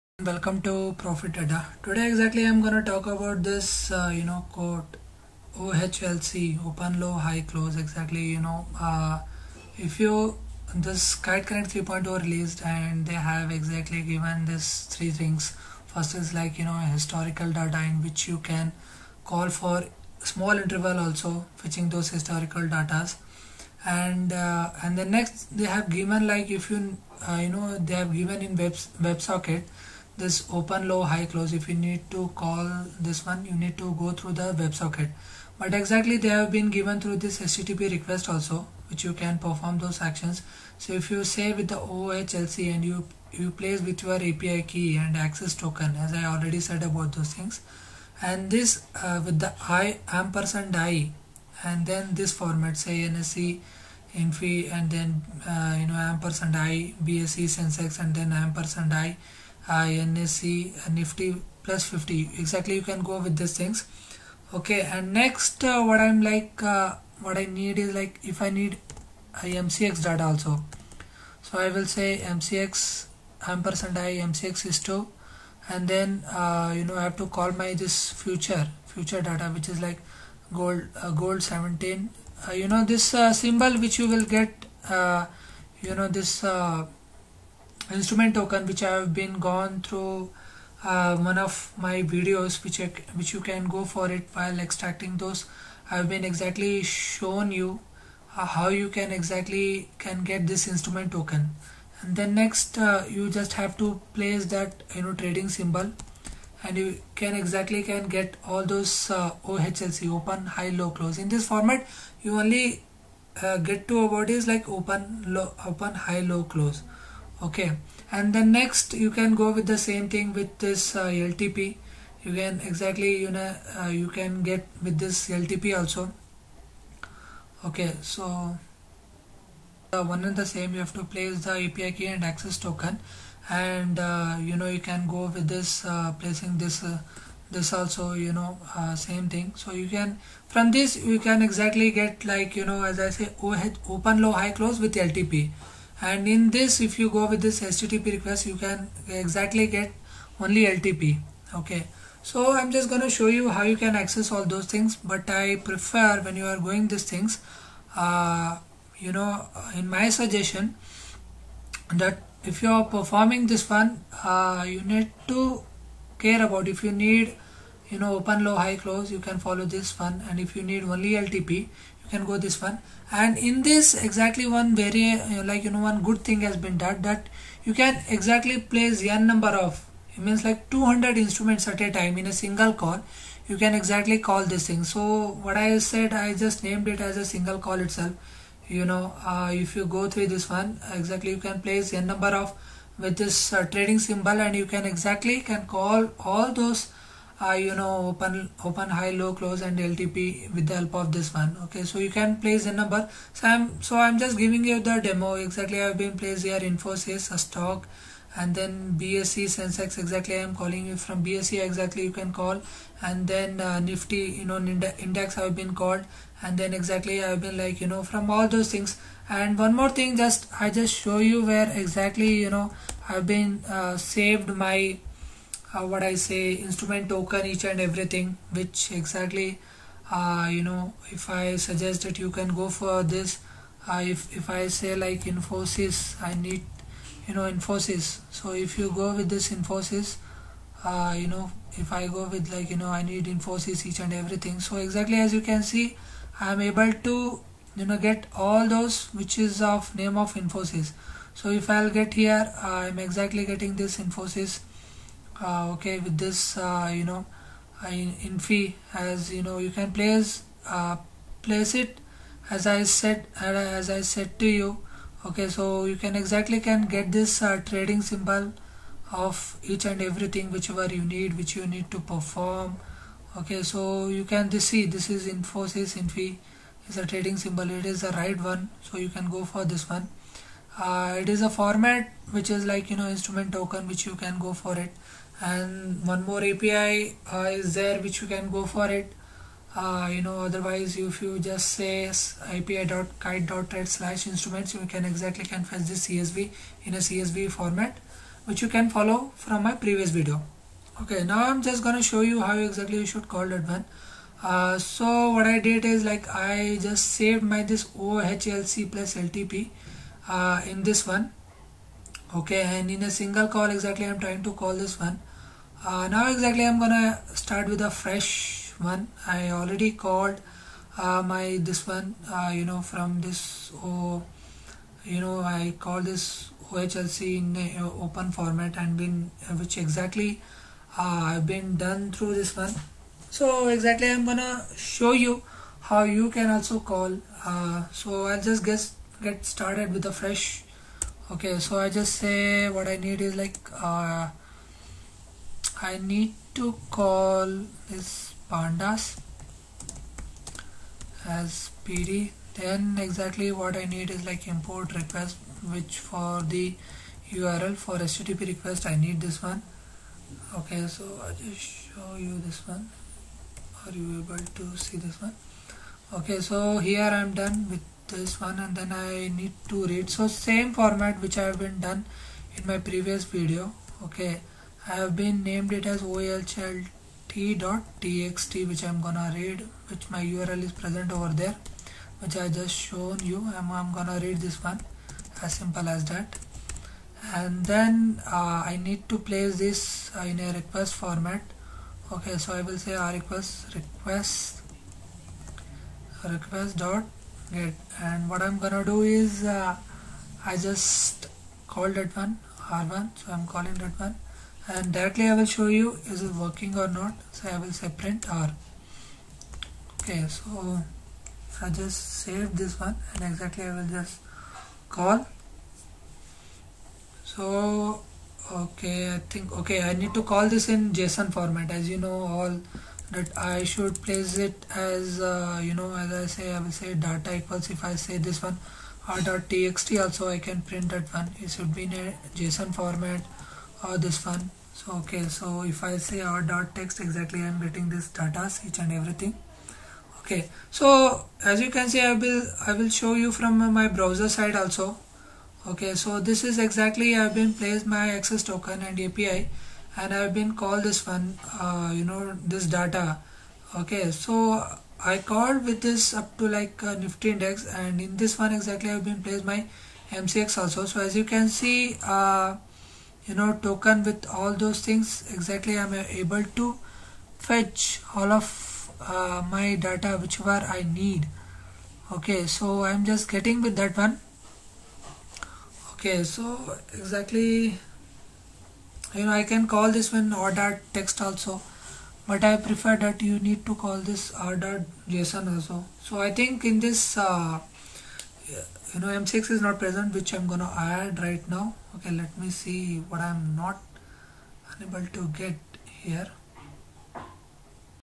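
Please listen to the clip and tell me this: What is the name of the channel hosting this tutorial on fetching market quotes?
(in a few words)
Profit Adda.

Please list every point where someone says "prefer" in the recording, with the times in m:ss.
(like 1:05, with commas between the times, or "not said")
2:35, 8:02.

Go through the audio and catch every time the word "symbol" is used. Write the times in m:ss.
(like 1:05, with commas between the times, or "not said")
1:23, 1:45, 3:14, 4:28, 4:37.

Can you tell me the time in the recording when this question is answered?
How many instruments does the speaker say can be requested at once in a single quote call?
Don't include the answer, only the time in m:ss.
3:00.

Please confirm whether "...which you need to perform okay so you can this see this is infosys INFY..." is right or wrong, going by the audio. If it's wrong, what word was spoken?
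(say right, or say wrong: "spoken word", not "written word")
right.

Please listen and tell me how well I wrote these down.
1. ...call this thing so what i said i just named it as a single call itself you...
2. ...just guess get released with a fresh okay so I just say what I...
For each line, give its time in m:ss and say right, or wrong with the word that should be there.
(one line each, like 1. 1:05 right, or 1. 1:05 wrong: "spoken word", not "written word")
1. 3:04 right
2. 5:38 wrong: "started", not "released".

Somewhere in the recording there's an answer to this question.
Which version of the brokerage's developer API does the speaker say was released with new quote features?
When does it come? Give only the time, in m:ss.
0:11.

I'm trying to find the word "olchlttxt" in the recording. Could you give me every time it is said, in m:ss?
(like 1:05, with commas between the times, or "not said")
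6:16.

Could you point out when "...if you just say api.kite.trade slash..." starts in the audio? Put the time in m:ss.
4:50.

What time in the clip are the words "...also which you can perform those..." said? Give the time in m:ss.
0:38.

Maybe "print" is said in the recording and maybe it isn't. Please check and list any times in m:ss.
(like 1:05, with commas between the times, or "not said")
6:47, 7:10.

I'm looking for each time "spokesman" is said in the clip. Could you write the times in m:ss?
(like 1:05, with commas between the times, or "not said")
not said.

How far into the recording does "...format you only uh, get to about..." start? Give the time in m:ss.
1:51.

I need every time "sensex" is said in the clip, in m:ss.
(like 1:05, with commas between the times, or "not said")
0:57, 3:29.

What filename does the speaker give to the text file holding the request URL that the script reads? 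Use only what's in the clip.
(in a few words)
olchlt.txt.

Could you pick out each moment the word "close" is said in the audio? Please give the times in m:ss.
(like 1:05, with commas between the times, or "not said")
0:07, 0:31, 1:50, 1:56, 2:24, 2:48, 3:19.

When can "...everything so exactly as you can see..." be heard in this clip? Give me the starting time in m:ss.
4:04.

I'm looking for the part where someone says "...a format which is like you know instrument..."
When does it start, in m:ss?
4:41.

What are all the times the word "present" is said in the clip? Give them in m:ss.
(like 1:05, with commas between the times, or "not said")
6:20, 8:09.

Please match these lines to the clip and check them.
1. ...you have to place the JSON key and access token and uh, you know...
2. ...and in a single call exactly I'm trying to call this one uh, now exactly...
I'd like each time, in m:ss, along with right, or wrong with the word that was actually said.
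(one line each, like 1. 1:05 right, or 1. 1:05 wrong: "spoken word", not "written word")
1. 2:10 wrong: "API", not "JSON"
2. 5:12 right.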